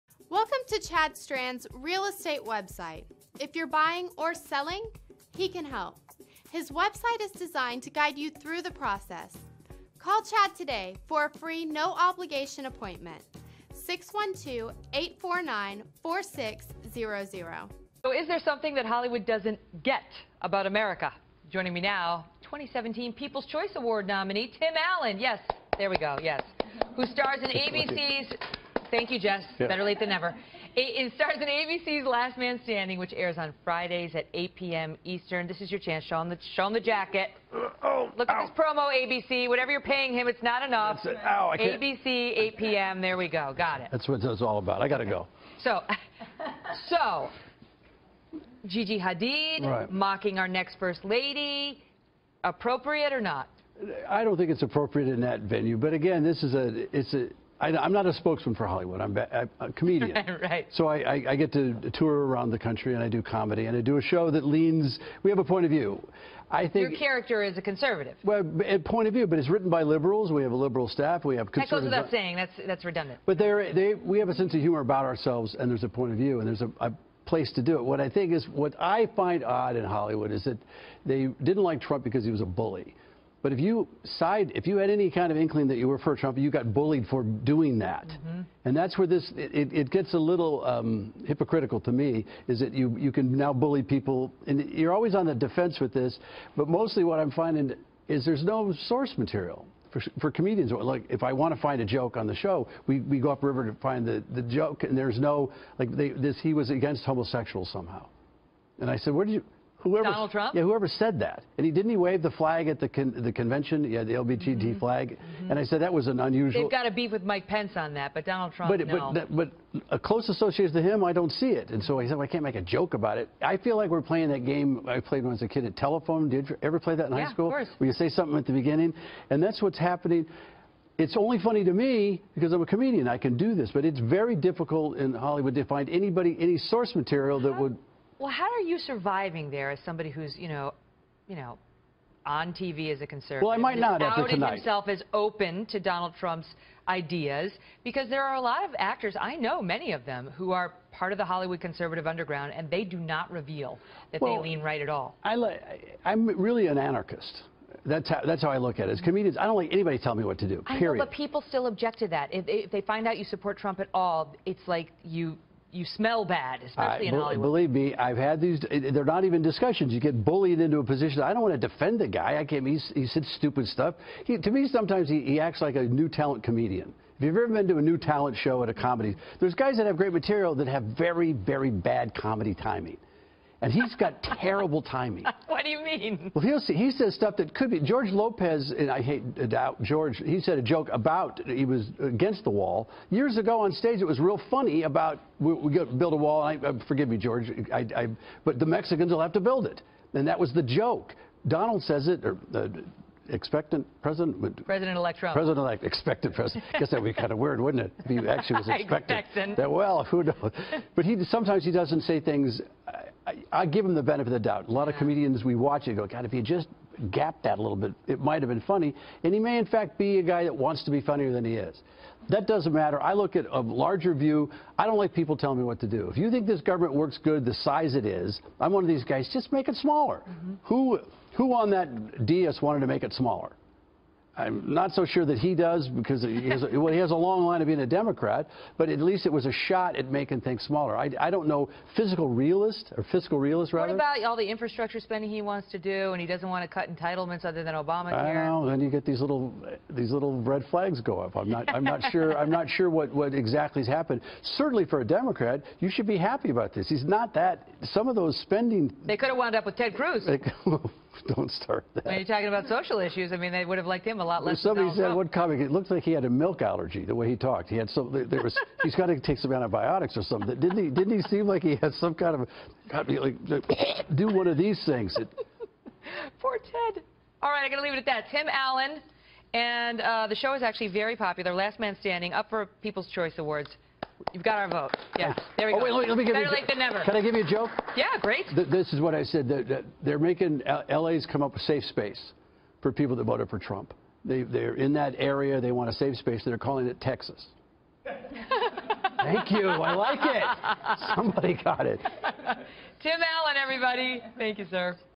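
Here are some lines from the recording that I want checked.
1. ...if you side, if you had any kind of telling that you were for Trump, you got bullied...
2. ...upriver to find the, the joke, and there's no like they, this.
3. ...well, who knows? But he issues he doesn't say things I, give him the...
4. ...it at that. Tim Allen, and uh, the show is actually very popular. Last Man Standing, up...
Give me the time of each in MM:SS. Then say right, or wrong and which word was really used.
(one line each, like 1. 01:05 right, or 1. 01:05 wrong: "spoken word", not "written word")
1. 01:23 wrong: "inkling", not "telling"
2. 01:43 right
3. 03:29 wrong: "sometimes", not "issues"
4. 04:37 right.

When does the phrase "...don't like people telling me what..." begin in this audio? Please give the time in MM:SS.
03:44.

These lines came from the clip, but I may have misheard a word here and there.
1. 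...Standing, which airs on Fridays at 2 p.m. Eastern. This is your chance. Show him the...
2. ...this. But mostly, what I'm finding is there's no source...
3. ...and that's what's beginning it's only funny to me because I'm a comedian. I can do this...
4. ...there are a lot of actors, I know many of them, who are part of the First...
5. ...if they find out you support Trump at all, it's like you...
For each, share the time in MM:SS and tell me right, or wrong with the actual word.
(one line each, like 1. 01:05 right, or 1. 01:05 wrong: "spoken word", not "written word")
1. 00:32 wrong: "8", not "2"
2. 01:35 right
3. 02:09 wrong: "happening", not "beginning"
4. 02:28 wrong: "Hollywood", not "First"
5. 02:42 right.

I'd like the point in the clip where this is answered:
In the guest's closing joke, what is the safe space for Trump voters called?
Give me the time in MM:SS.
04:57.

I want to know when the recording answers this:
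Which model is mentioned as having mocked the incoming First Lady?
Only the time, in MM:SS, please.
00:48.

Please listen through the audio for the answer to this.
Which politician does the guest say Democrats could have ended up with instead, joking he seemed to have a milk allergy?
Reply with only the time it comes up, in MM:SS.
04:19.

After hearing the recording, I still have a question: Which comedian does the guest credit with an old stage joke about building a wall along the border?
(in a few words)
George Lopez.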